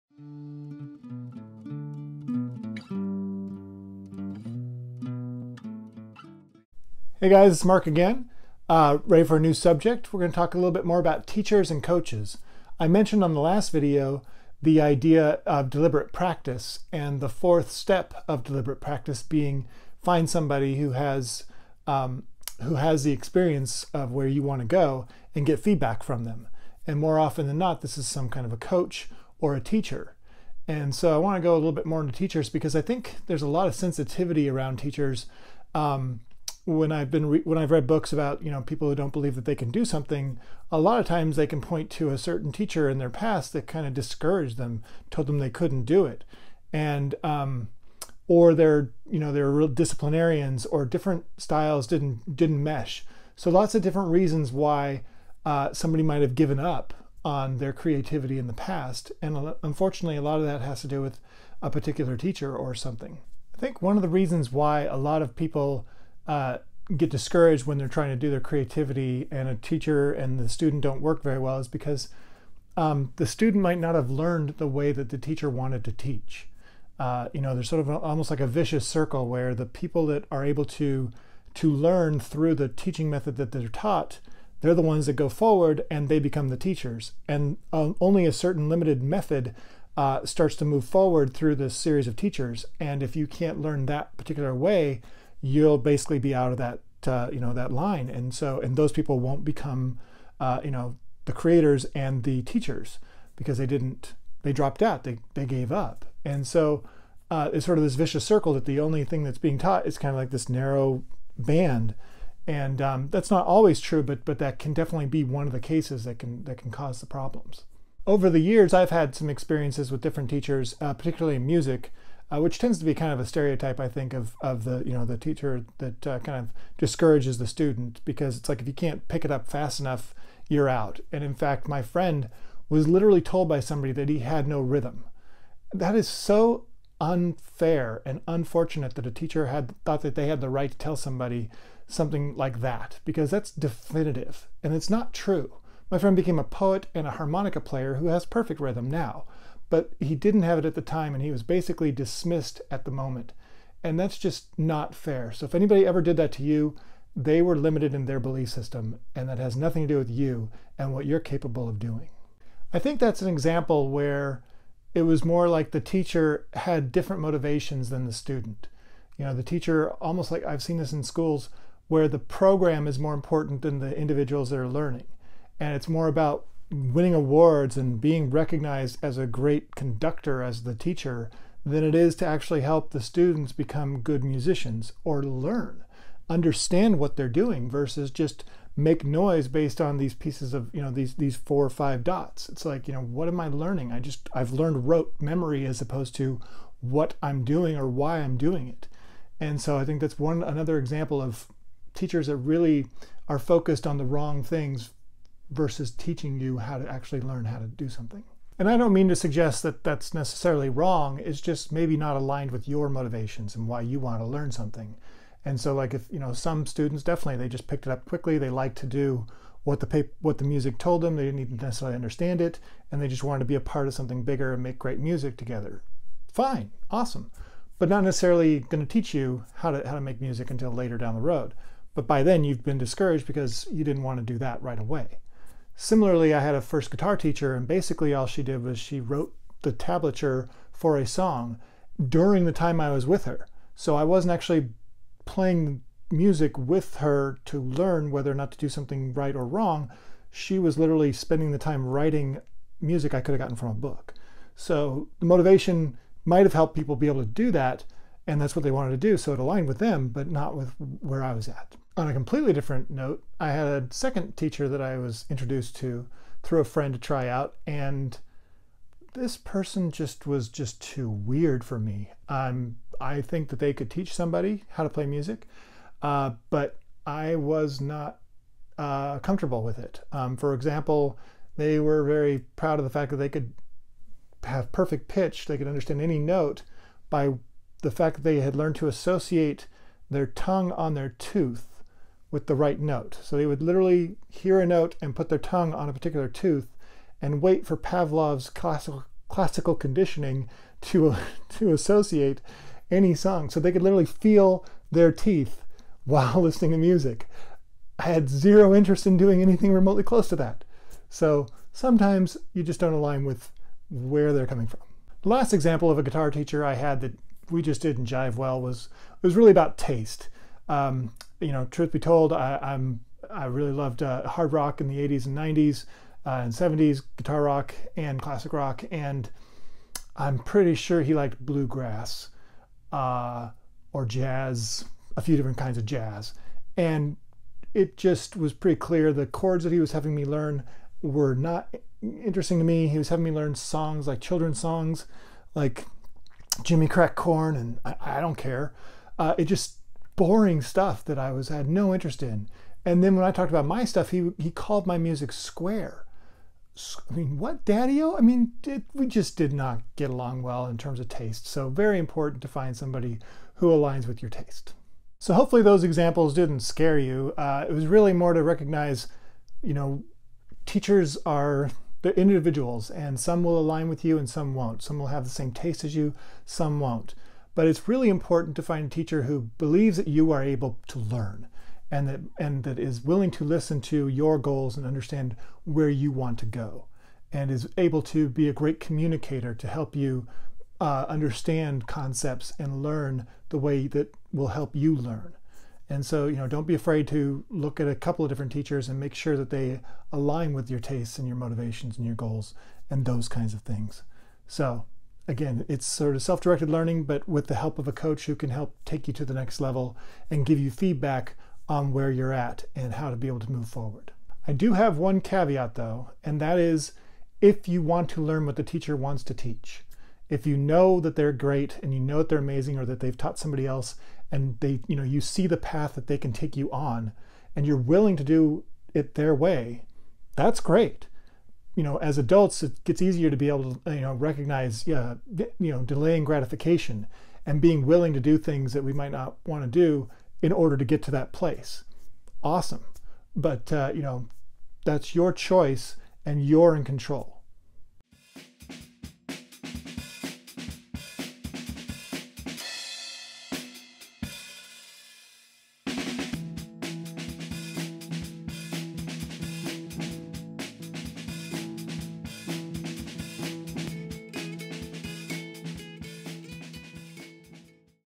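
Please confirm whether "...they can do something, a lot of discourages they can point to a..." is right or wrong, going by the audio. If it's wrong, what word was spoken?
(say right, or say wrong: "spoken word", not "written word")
wrong: "times", not "discourages".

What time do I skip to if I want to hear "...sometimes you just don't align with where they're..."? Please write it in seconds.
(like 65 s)
311 s.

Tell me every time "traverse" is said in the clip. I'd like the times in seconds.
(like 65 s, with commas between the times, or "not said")
not said.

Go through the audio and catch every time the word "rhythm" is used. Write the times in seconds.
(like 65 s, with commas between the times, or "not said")
134 s, 148 s.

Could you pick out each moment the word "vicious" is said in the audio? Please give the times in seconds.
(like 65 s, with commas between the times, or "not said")
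78 s, 107 s.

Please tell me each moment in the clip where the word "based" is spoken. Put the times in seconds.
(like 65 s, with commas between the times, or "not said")
189 s.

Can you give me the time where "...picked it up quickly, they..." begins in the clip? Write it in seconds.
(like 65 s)
217 s.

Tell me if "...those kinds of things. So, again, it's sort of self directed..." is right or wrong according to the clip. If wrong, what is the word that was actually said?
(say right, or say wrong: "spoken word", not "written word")
right.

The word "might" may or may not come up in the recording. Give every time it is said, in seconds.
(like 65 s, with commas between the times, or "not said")
56 s, 73 s, 256 s, 438 s.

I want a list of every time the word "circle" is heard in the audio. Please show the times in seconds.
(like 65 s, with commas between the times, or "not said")
78 s, 108 s.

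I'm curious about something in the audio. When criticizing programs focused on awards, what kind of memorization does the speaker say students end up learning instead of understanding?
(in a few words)
Rote memory.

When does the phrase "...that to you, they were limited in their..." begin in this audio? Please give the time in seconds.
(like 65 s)
156 s.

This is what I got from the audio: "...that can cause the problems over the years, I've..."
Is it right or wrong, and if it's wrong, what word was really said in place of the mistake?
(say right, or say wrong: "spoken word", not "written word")
right.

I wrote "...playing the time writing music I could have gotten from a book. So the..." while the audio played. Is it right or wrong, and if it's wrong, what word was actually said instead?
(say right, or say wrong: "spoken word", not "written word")
wrong: "spending", not "playing".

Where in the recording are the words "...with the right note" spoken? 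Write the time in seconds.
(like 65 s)
292 s.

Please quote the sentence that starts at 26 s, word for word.
And more often than not, this is some kind of a coach or a teacher.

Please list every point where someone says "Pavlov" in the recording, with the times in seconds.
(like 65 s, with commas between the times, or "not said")
297 s.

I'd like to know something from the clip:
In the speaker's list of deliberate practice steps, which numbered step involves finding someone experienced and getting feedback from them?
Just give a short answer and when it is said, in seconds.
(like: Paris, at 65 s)
Fourth, at 17 s.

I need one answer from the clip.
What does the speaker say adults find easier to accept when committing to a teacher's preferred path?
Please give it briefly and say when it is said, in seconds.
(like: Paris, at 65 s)
Delaying gratification, at 435 s.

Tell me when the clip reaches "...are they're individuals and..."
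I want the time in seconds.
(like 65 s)
371 s.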